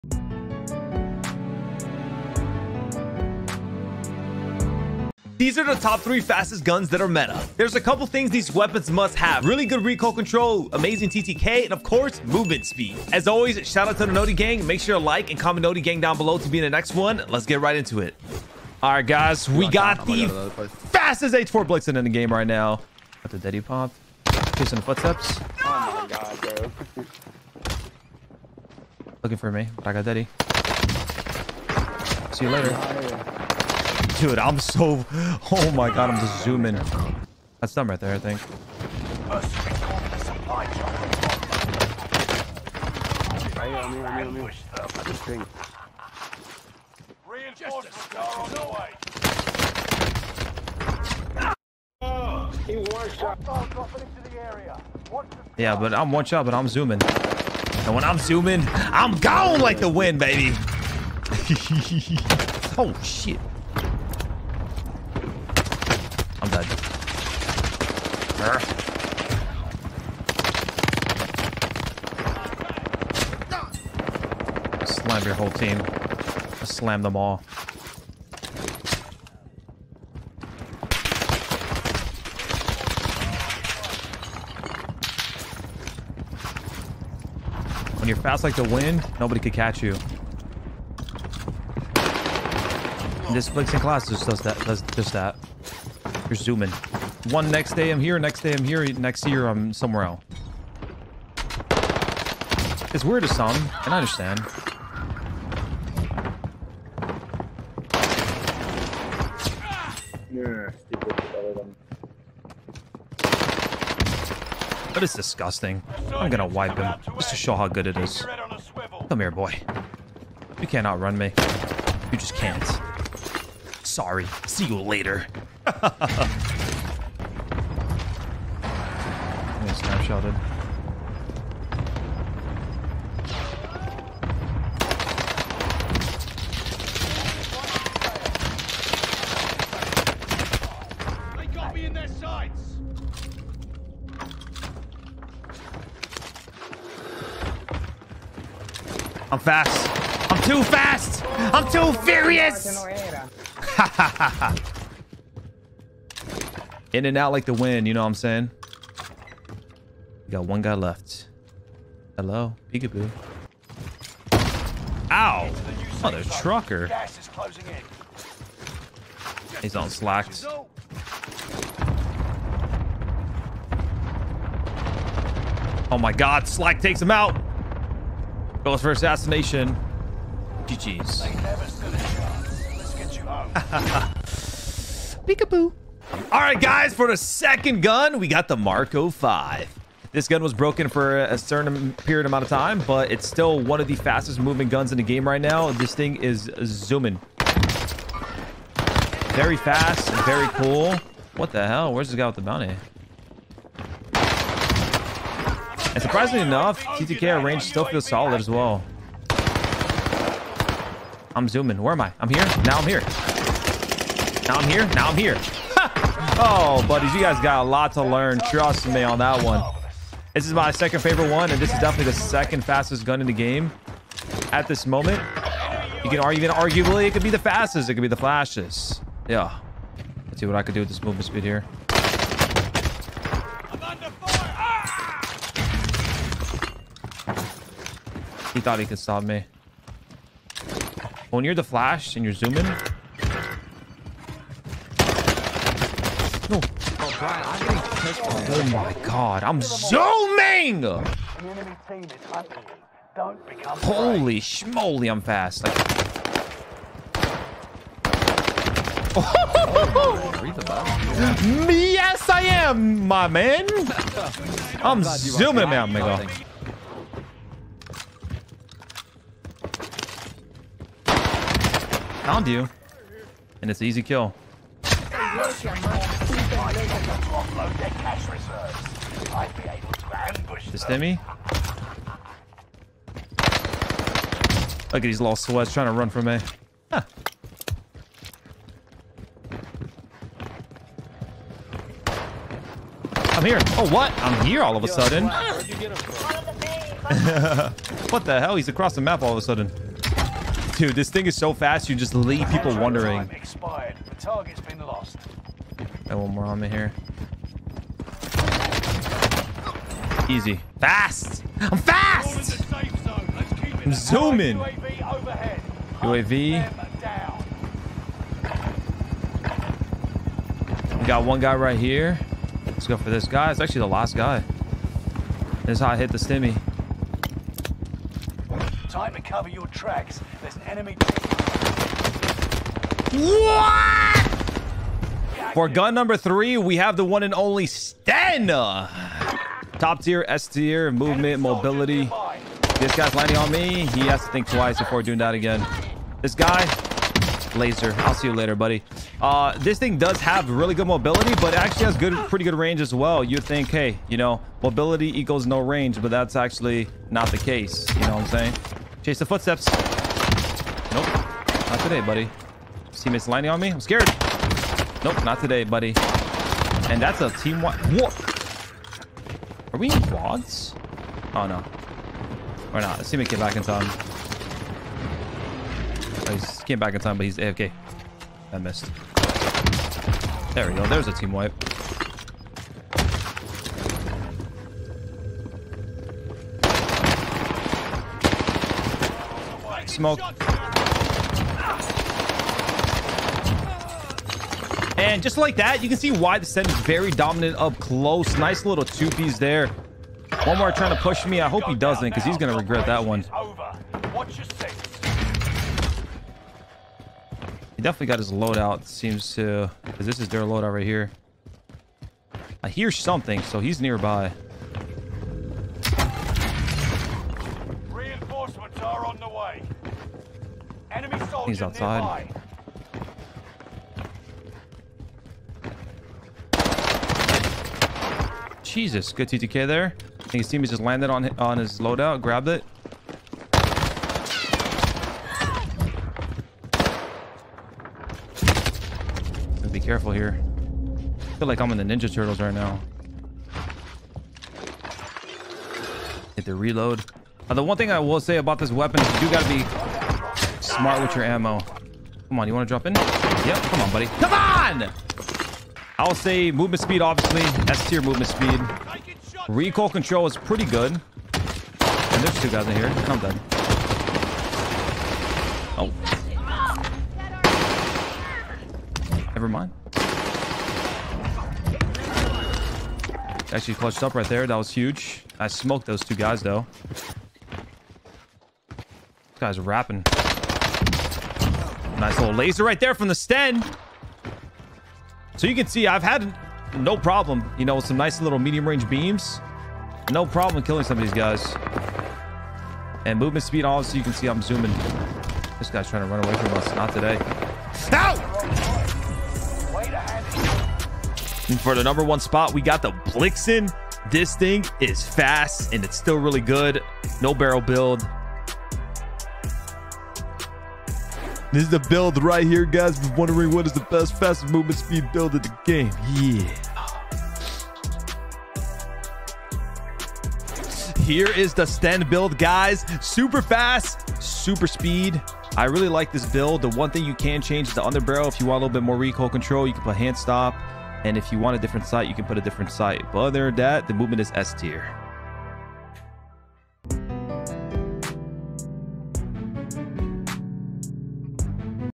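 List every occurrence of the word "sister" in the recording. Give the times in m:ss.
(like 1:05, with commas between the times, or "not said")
not said.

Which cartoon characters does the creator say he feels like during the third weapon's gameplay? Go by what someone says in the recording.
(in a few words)
Ninja Turtles.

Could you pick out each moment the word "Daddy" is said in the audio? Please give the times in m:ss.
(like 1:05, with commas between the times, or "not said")
0:23, 0:30.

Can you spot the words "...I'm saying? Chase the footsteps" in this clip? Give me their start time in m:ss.
5:58.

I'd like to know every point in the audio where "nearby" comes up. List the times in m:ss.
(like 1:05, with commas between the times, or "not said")
6:53, 7:02.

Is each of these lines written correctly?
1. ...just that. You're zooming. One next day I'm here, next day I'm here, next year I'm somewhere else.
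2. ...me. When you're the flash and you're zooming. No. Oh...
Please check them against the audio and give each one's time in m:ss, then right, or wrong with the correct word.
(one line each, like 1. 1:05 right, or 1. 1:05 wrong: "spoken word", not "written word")
1. 1:34 right
2. 3:59 right.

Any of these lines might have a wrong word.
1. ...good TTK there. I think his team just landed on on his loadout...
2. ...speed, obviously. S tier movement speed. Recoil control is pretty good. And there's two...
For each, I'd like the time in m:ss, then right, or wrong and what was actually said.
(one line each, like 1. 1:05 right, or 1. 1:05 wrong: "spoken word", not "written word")
1. 7:09 right
2. 7:36 right.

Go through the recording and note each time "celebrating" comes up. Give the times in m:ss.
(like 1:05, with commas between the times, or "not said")
not said.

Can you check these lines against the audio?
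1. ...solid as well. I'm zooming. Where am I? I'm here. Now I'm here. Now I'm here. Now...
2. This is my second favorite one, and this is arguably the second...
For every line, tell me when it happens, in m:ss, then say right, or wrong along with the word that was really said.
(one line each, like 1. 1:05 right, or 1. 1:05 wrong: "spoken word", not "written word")
1. 3:28 right
2. 3:40 wrong: "definitely", not "arguably".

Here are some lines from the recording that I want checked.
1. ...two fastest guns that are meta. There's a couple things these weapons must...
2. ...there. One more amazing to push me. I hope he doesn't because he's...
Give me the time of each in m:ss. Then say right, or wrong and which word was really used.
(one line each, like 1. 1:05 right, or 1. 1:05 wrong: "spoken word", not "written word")
1. 0:06 wrong: "three", not "two"
2. 6:39 wrong: "trying", not "amazing".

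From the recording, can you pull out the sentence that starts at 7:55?
I smoked those two guys, though.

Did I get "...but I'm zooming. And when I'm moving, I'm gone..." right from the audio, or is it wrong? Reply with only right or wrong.
wrong.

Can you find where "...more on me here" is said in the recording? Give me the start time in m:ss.
5:06.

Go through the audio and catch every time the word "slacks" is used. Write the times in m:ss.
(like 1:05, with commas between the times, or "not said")
2:49, 2:56.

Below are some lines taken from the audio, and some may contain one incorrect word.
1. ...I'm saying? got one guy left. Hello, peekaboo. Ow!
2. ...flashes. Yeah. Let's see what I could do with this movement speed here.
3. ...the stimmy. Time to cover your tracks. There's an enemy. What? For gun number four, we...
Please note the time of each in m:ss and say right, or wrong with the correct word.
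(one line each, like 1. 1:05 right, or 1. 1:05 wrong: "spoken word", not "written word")
1. 2:38 right
2. 3:48 right
3. 5:26 wrong: "three", not "four".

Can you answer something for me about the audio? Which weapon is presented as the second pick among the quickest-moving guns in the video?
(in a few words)
Marco 5.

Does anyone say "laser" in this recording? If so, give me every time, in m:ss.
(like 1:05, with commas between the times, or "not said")
5:47, 8:02.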